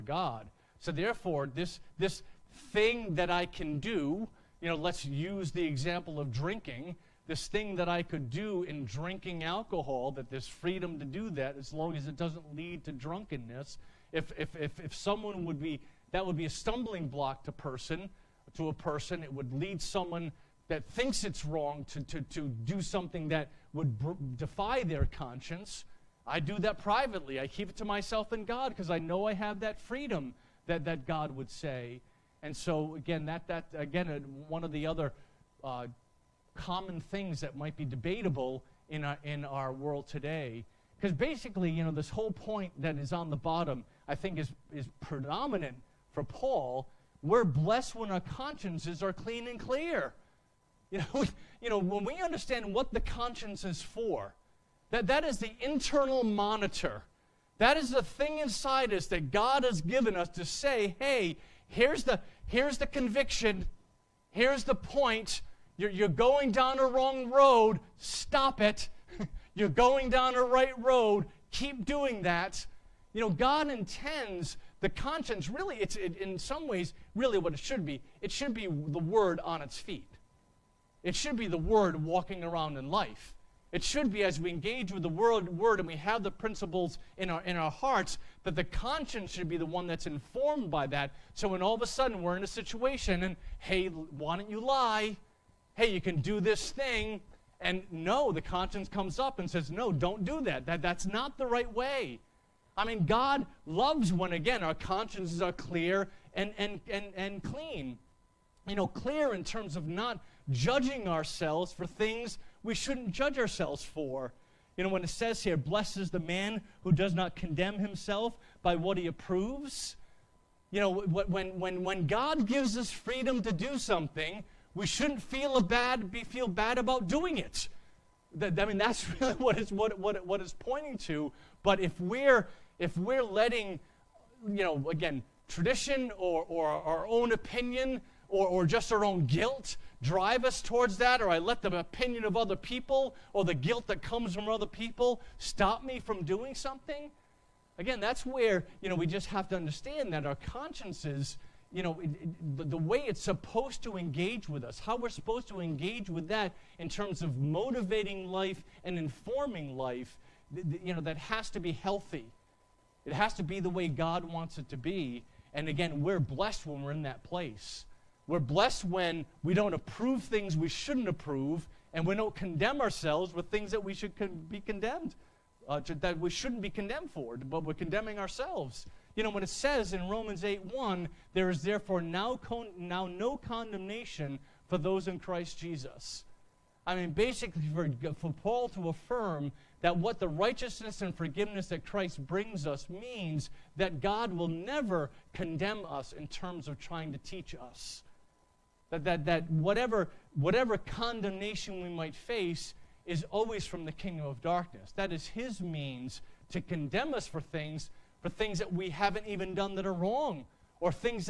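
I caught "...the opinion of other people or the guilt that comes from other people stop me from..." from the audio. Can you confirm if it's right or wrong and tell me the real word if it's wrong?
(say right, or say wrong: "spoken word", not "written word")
right.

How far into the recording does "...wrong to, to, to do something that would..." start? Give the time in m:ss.
0:21.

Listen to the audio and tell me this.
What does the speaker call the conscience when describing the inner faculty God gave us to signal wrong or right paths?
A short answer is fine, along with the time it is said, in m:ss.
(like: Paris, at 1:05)
Internal monitor, at 0:55.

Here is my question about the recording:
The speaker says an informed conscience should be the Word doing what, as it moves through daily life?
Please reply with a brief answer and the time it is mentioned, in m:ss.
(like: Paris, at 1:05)
Walking around, at 1:22.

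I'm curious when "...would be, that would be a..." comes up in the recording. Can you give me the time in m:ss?
0:15.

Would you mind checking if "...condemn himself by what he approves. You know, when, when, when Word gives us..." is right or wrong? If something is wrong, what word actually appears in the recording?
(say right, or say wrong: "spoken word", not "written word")
wrong: "God", not "Word".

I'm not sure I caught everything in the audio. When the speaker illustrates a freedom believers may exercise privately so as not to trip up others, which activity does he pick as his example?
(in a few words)
Drinking alcohol.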